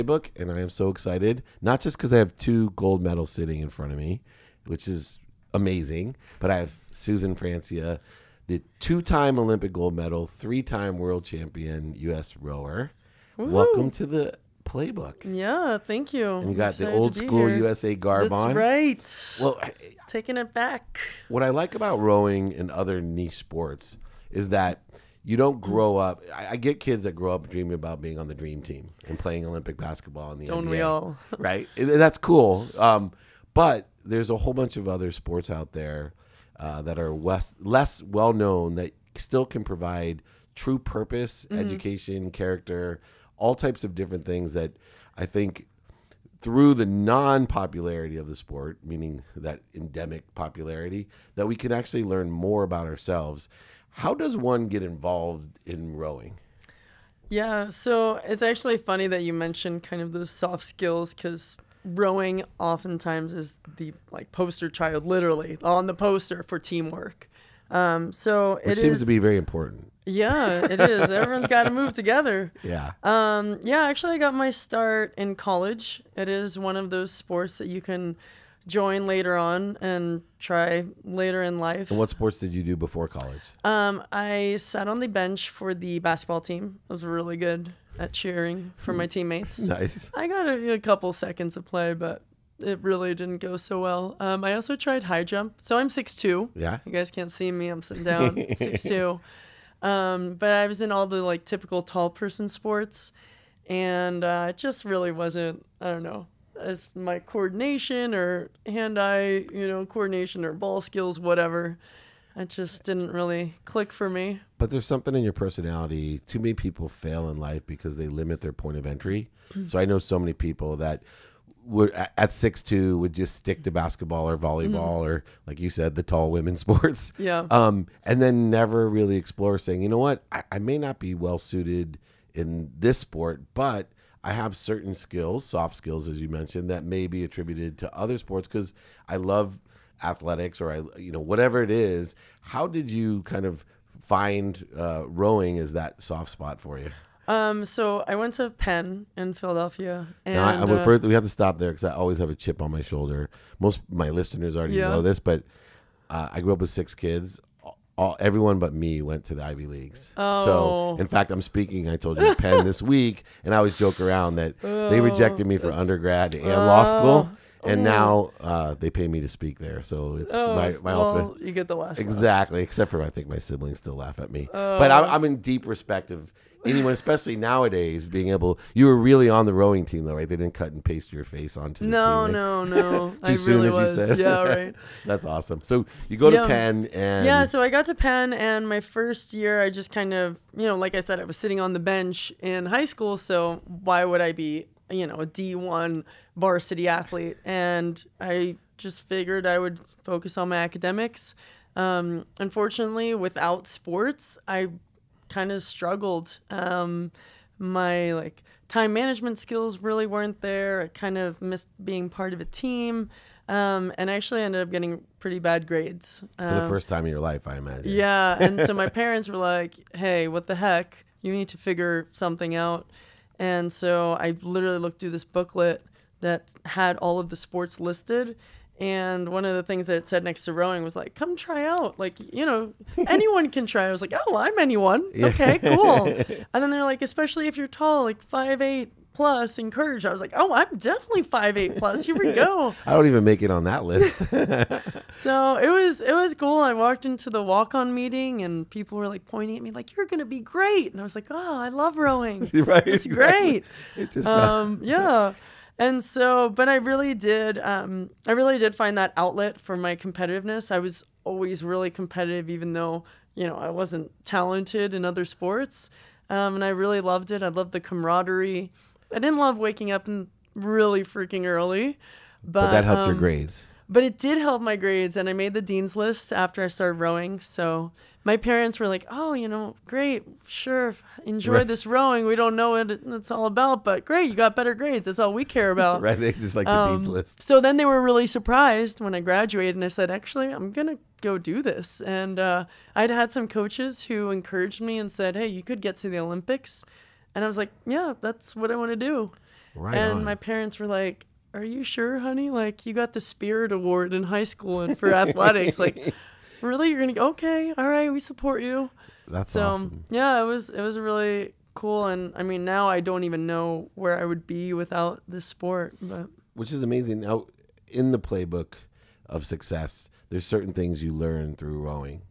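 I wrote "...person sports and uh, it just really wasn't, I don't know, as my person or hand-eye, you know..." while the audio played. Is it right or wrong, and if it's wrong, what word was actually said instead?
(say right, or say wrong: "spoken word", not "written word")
wrong: "coordination", not "person".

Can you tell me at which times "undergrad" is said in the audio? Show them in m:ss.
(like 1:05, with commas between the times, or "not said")
2:45.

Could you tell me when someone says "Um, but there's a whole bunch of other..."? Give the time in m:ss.
0:32.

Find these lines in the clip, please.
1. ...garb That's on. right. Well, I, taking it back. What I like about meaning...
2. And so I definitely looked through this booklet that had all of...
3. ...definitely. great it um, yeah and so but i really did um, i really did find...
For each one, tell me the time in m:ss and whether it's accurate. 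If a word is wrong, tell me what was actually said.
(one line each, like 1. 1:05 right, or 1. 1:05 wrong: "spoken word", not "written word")
1. 0:17 wrong: "rowing", not "meaning"
2. 3:43 wrong: "literally", not "definitely"
3. 4:13 wrong: "exactly", not "definitely".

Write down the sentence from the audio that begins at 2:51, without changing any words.
You get the last exactly, laugh.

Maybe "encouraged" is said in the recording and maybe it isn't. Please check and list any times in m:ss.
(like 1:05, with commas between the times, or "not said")
3:59, 4:54.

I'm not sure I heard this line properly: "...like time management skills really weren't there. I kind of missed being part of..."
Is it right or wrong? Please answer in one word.
right.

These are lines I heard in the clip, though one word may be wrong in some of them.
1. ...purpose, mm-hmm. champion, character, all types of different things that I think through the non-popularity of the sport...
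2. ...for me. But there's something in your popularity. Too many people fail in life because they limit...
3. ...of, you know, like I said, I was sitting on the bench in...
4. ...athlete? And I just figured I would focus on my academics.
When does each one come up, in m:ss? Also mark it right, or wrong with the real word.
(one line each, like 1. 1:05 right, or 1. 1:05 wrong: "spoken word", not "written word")
1. 0:40 wrong: "education", not "champion"
2. 1:53 wrong: "personality", not "popularity"
3. 3:10 right
4. 3:16 right.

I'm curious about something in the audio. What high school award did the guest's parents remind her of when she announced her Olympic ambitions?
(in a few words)
Spirit Award.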